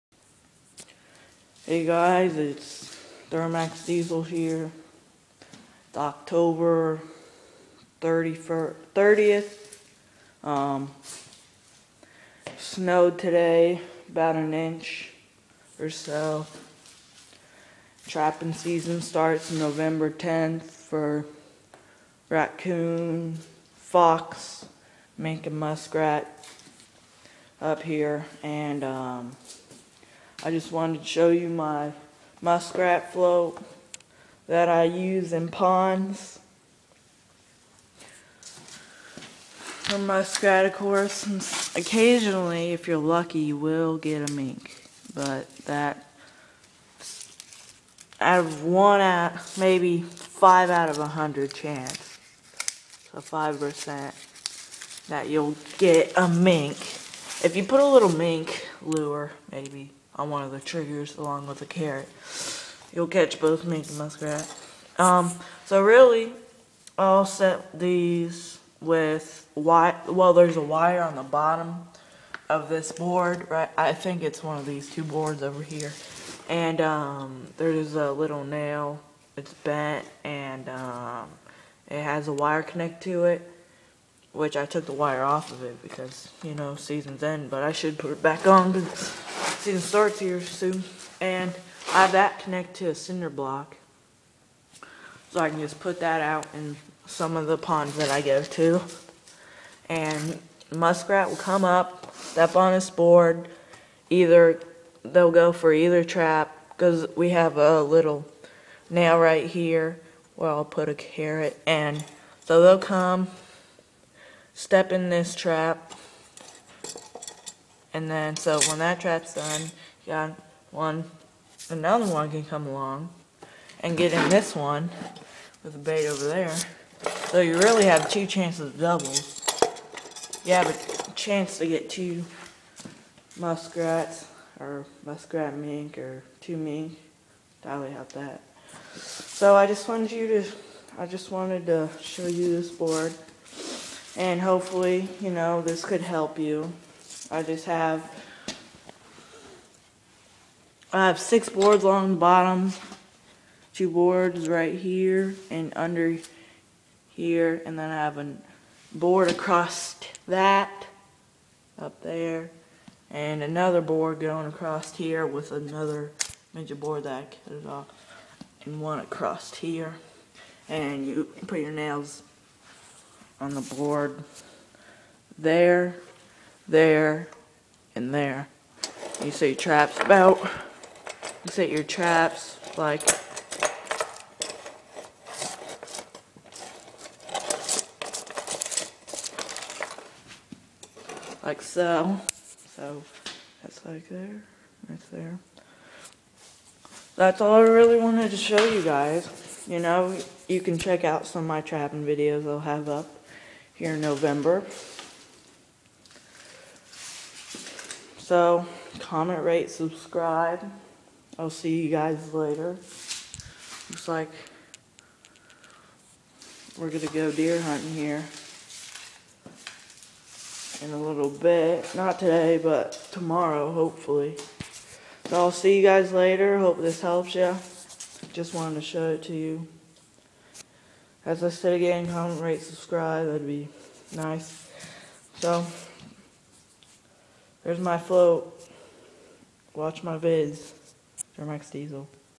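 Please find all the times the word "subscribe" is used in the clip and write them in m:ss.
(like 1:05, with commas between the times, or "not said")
3:29, 3:52.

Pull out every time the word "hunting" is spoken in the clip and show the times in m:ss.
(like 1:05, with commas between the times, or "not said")
3:37.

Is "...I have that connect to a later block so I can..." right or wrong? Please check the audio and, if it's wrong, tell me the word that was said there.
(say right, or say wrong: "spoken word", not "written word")
wrong: "cinder", not "later".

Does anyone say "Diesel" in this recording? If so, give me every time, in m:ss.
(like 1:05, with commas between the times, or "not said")
0:03, 4:01.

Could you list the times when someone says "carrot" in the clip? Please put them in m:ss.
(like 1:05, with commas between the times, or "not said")
1:01, 1:50.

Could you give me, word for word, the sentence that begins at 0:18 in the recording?
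Trapping season starts November 10th for raccoon, fox, mink, and muskrat up here.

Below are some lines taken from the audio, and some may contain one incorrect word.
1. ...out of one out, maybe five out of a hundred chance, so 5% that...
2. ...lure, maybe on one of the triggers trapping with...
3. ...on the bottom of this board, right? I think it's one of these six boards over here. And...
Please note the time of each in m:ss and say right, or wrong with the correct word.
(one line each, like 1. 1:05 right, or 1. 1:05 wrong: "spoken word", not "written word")
1. 0:48 right
2. 0:58 wrong: "along", not "trapping"
3. 1:11 wrong: "two", not "six".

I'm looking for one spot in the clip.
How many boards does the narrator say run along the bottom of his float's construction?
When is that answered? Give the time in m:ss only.
2:31.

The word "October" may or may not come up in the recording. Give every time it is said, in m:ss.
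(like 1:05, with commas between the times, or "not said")
0:05.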